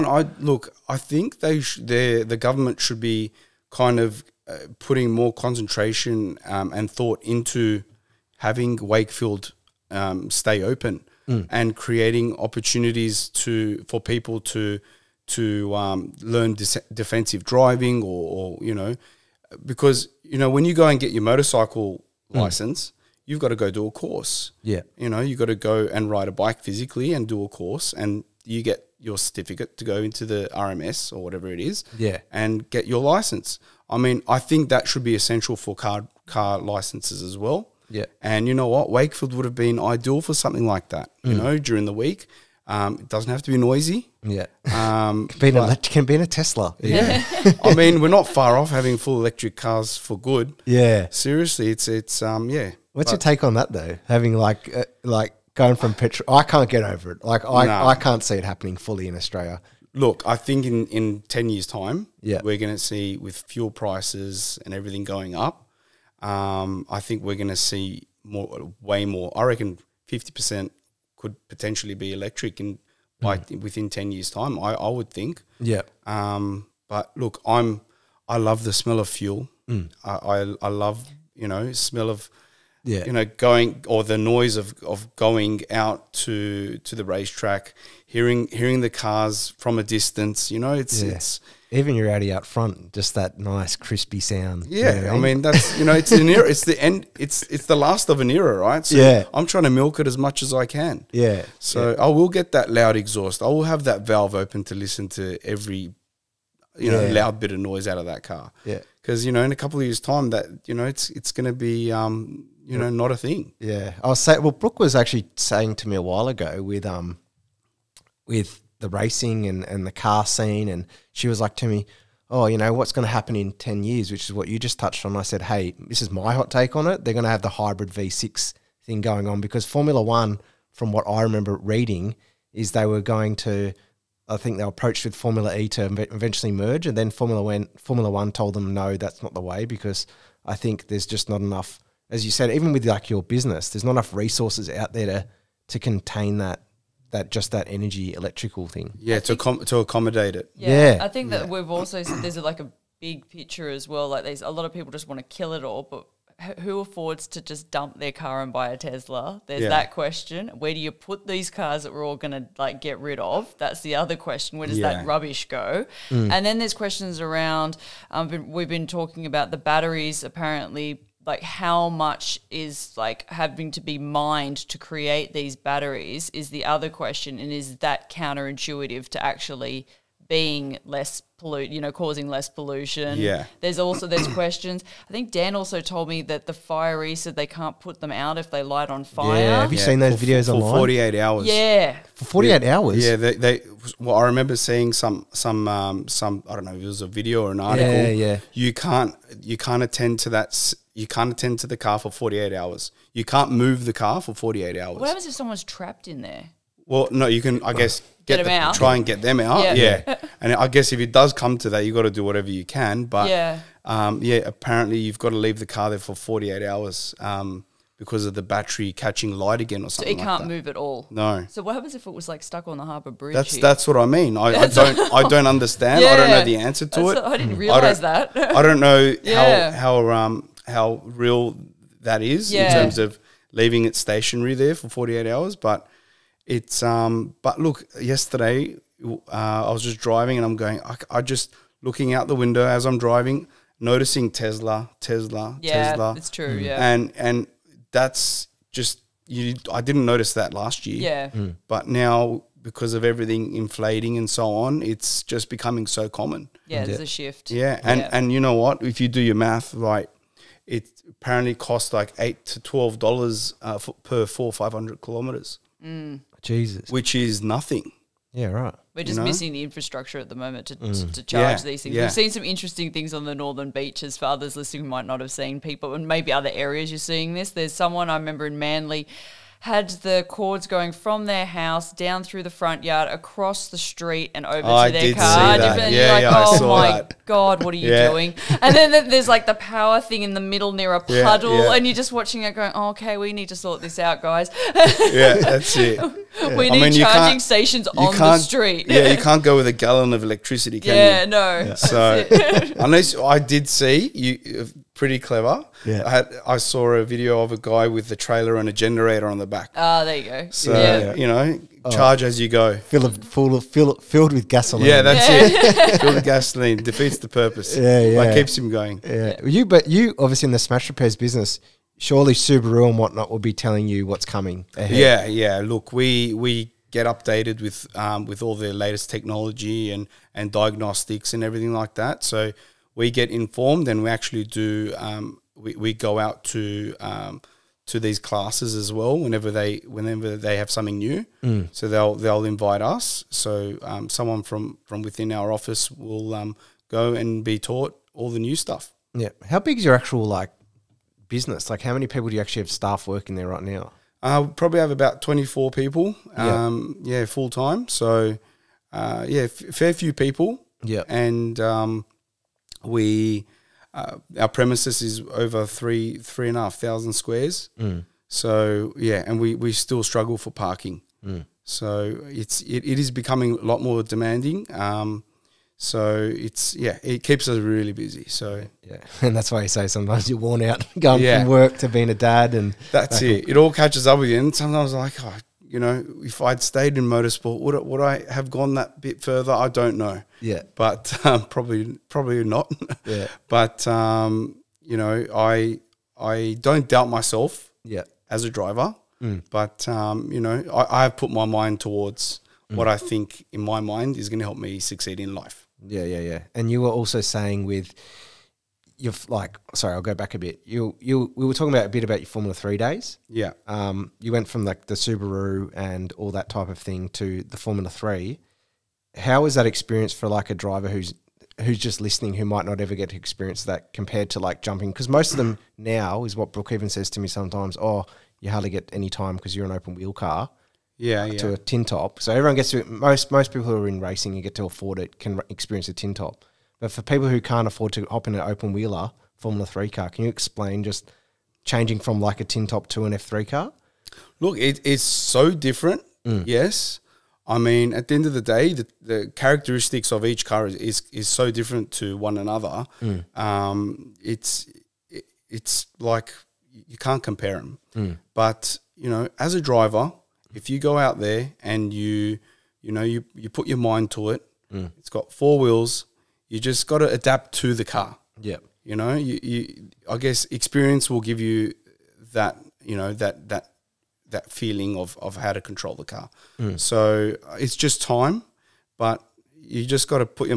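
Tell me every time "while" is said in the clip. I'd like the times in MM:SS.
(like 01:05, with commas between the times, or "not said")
01:56.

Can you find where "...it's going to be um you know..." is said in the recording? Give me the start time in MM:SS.
01:51.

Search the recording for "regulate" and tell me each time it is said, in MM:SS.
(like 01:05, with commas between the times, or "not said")
not said.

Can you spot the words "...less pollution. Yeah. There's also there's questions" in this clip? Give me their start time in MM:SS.
03:02.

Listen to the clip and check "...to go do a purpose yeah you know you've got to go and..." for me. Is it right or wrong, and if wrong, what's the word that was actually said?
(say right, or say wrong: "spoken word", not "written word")
wrong: "course", not "purpose".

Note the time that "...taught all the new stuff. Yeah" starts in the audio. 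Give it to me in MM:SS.
05:47.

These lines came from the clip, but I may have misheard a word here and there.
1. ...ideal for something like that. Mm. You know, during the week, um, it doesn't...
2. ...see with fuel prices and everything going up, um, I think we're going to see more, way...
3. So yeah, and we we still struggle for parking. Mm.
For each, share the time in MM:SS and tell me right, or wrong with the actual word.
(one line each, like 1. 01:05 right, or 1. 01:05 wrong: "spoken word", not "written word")
1. 00:39 right
2. 01:02 right
3. 06:08 right.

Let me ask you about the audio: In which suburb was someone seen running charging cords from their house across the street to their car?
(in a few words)
Manly.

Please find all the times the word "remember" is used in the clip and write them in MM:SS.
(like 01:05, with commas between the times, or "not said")
02:11, 03:14, 04:38.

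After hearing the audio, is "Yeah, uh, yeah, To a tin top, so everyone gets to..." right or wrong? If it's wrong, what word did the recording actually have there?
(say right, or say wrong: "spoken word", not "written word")
right.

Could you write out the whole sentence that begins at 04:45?
And yeah, you're yeah, like, oh my that.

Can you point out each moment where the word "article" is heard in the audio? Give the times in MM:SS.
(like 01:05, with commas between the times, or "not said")
03:17.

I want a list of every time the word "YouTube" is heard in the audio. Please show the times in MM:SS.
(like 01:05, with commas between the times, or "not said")
not said.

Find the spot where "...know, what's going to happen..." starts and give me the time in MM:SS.
02:02.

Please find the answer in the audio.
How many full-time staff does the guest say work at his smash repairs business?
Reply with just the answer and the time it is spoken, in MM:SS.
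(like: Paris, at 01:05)
24, at 05:55.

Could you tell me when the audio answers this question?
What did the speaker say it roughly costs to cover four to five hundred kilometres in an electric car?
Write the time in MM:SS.
04:22.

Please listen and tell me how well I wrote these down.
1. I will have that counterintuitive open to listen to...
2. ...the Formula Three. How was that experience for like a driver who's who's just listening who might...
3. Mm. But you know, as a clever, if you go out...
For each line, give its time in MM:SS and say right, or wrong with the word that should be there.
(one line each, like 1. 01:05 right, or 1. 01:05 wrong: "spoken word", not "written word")
1. 01:43 wrong: "valve", not "counterintuitive"
2. 06:57 right
3. 07:37 wrong: "driver", not "clever".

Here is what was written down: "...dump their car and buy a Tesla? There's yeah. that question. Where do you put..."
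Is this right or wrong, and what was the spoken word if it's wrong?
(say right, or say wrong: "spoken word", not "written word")
right.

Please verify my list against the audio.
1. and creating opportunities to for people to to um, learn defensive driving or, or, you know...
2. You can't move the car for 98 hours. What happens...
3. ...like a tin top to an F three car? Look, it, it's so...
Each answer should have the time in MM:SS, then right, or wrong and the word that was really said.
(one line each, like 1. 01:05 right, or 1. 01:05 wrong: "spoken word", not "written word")
1. 00:11 right
2. 03:23 wrong: "48", not "98"
3. 07:22 right.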